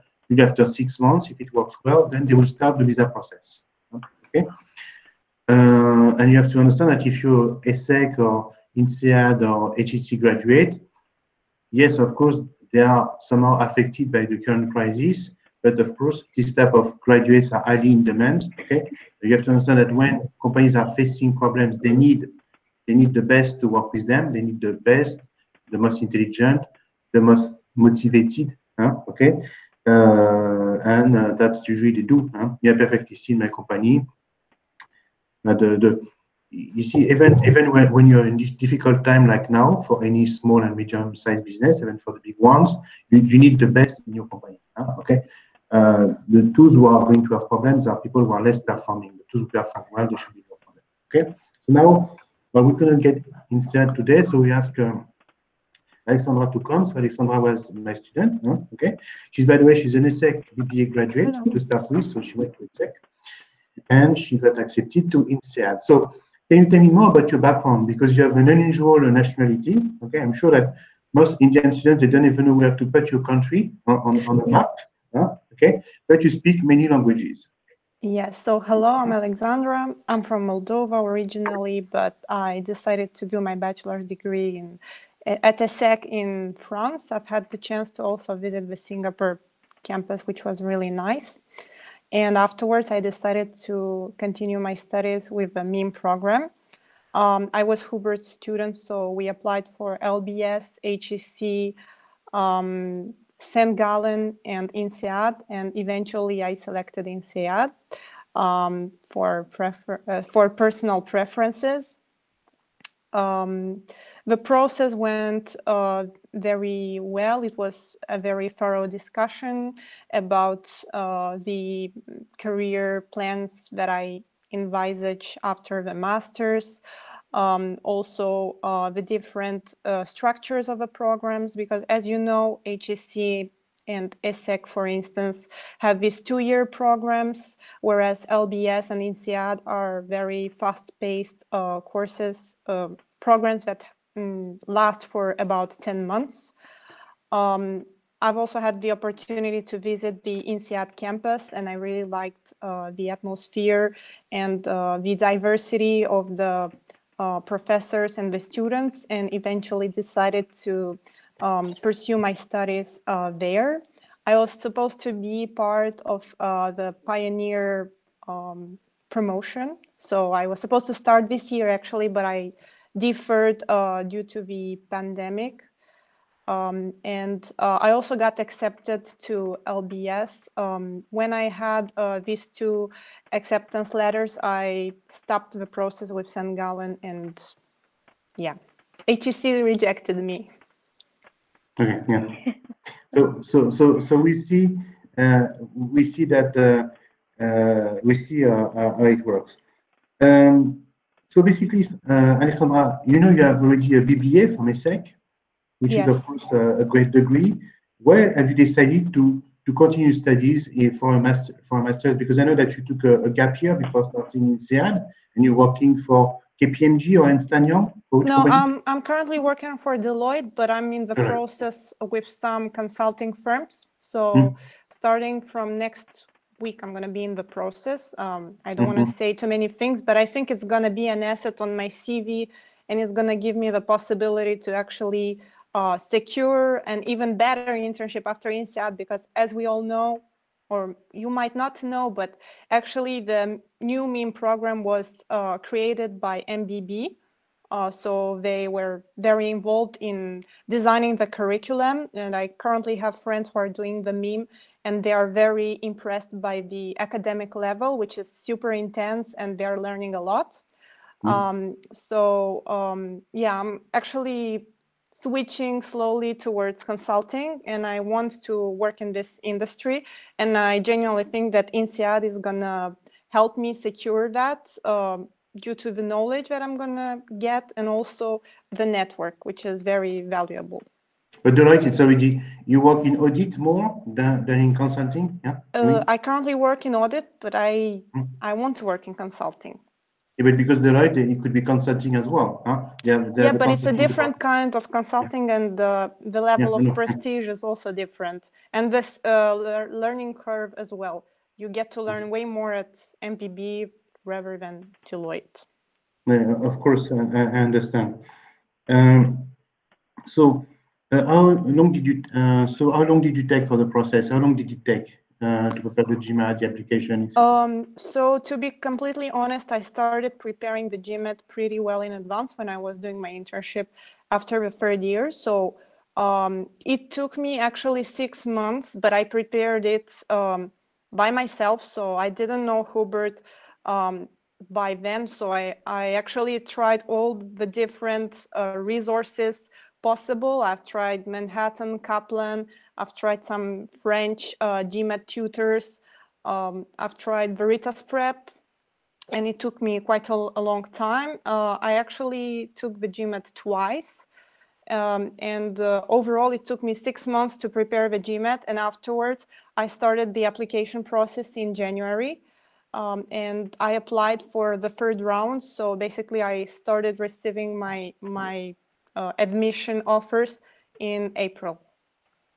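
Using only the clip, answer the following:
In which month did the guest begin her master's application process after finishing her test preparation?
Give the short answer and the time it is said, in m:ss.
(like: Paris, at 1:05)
January, at 6:01.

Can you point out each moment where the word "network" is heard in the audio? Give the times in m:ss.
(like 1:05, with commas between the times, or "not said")
4:38.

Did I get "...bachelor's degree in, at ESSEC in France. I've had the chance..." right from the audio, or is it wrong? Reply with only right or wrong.
right.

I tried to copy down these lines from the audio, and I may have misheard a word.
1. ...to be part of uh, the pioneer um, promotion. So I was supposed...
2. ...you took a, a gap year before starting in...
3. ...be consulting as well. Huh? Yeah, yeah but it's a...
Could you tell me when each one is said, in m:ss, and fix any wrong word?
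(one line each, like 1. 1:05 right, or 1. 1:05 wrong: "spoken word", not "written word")
1. 2:45 right
2. 3:32 right
3. 4:51 right.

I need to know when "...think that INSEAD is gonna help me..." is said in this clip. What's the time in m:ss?
4:31.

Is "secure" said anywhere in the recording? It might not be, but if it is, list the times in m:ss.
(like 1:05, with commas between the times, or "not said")
3:55, 4:33.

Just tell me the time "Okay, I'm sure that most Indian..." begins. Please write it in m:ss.
1:10.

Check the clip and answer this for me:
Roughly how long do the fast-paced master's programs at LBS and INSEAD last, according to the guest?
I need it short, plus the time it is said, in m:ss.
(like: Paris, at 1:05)
10 months, at 2:25.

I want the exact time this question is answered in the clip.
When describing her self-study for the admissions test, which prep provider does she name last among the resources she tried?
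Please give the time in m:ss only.
5:47.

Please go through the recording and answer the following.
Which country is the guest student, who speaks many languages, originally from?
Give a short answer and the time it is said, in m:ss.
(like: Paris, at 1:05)
Moldova, at 1:20.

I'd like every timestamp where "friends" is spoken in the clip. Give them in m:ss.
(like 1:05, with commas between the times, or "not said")
4:13.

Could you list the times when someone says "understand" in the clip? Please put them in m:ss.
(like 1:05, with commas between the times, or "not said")
0:06, 0:19, 5:07.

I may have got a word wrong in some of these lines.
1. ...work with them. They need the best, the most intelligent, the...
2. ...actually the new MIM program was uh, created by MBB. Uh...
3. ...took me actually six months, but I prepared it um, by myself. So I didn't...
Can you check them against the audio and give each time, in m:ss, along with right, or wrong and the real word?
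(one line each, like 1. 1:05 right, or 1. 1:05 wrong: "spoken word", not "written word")
1. 0:23 right
2. 4:02 right
3. 5:27 right.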